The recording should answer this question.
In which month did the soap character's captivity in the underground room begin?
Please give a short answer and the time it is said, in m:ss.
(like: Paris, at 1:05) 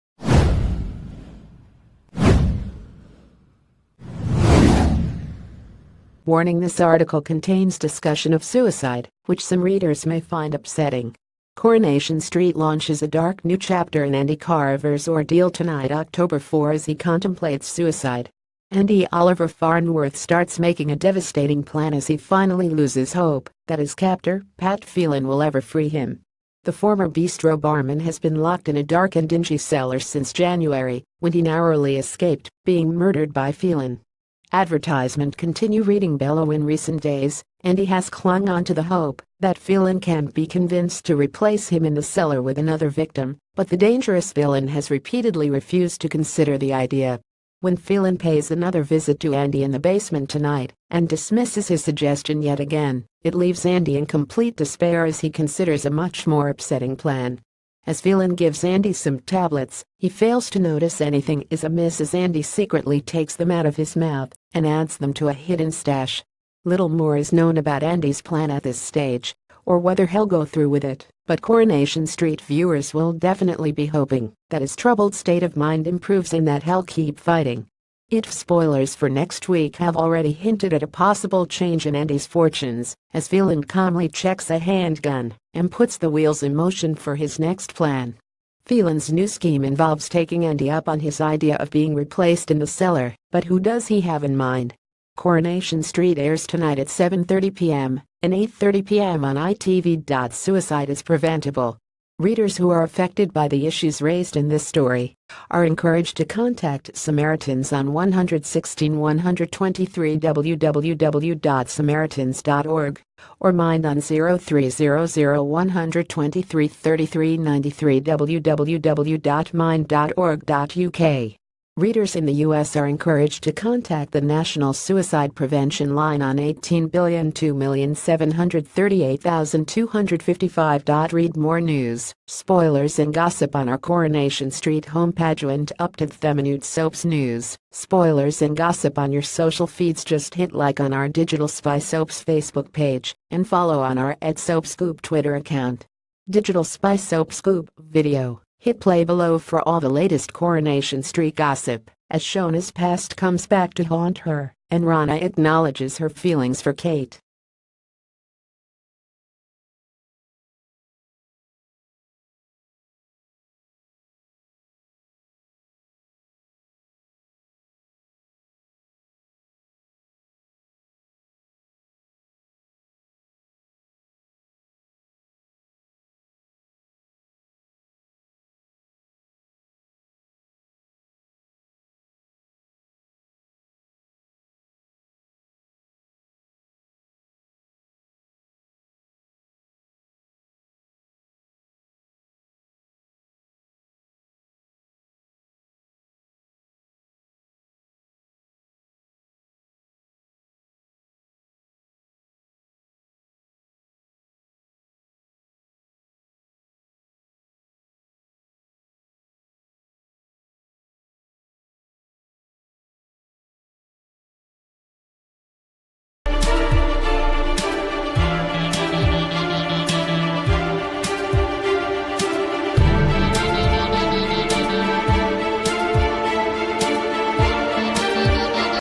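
January, at 0:30.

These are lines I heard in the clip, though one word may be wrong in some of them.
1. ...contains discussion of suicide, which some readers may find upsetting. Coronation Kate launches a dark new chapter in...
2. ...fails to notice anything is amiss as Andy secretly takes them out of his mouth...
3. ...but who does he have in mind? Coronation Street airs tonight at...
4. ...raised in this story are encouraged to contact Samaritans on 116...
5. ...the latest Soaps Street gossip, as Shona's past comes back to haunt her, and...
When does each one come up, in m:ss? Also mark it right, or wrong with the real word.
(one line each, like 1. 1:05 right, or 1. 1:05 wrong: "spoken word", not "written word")
1. 0:07 wrong: "Street", not "Kate"
2. 1:00 right
3. 1:33 right
4. 1:43 right
5. 2:29 wrong: "Coronation", not "Soaps".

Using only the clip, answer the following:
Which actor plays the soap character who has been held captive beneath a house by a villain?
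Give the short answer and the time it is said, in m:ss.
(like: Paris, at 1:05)
Oliver Farnworth, at 0:19.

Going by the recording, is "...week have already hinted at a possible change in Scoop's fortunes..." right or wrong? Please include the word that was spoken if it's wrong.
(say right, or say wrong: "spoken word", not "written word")
wrong: "Andy", not "Scoop".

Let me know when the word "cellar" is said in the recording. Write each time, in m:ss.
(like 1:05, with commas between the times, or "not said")
0:29, 0:42, 1:32.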